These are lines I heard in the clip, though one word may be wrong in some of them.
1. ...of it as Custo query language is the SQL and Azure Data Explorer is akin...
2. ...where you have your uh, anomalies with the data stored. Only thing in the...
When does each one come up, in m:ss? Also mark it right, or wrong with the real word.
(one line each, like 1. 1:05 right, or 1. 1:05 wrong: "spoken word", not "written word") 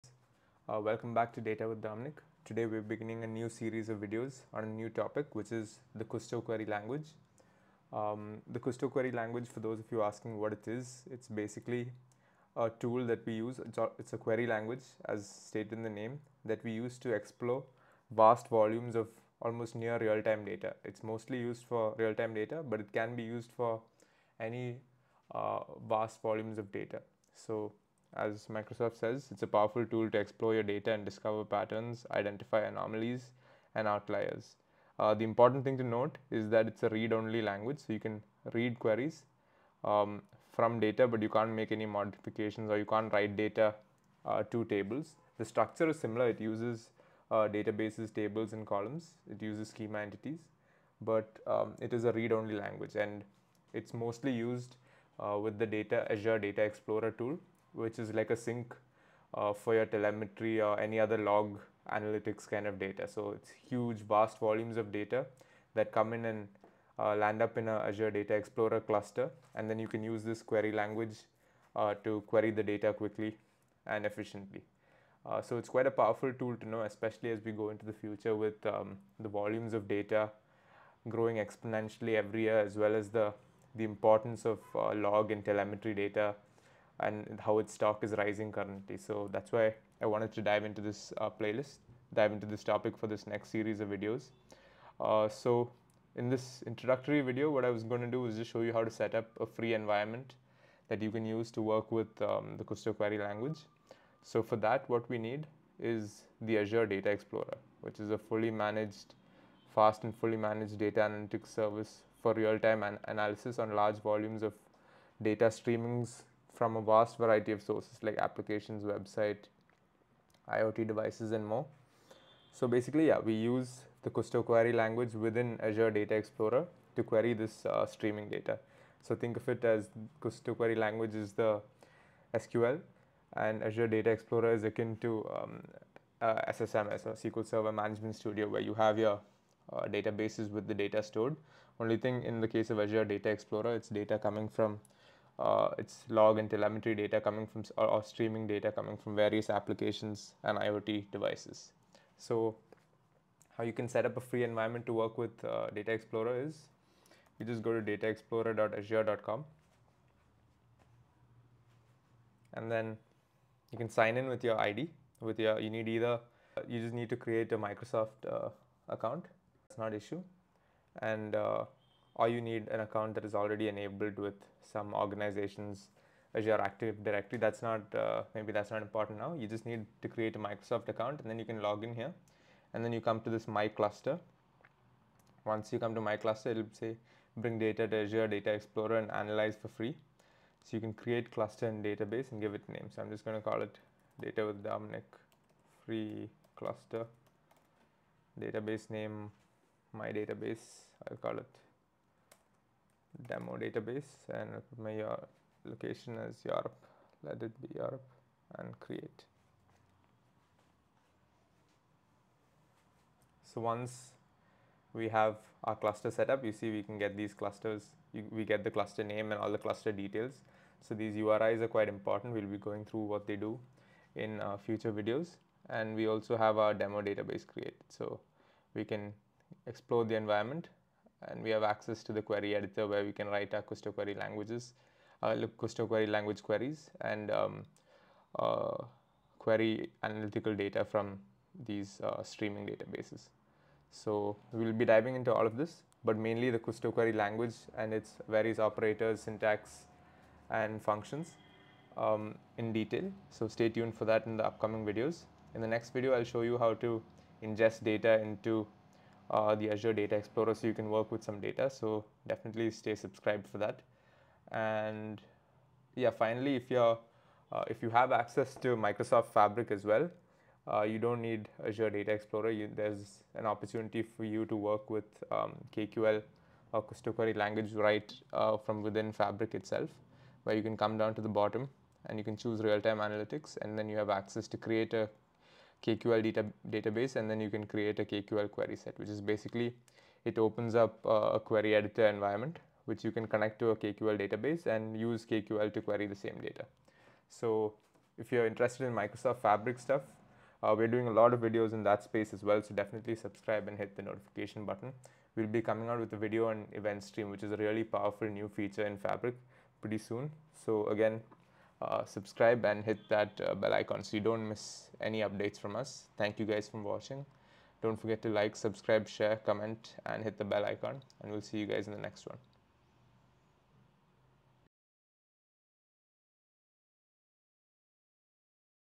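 1. 2:09 right
2. 2:18 wrong: "databases", not "anomalies".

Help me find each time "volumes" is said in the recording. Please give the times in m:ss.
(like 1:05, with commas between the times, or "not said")
0:18, 0:26, 1:04, 1:19, 1:54.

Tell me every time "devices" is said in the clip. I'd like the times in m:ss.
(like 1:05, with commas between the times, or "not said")
2:00, 2:31.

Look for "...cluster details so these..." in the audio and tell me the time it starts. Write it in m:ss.
3:39.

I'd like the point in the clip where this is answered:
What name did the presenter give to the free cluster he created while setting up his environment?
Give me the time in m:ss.
3:14.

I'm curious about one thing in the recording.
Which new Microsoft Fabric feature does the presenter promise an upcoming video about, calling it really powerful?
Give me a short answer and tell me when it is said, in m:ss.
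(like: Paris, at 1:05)
Event stream, at 5:06.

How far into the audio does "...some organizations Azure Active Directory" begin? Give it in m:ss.
2:54.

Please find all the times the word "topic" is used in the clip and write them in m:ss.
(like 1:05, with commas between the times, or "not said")
0:04, 1:32.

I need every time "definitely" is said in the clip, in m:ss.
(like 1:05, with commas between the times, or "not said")
4:22, 5:02.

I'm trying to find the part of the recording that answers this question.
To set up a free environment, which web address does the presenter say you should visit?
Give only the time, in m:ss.
2:37.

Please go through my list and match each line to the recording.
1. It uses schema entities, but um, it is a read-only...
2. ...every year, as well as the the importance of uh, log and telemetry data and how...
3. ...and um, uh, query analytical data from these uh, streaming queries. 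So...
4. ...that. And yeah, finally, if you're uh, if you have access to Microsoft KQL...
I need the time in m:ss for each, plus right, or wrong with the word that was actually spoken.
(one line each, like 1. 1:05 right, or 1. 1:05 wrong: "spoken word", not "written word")
1. 0:49 right
2. 1:22 right
3. 3:57 wrong: "databases", not "queries"
4. 4:23 wrong: "Fabric", not "KQL".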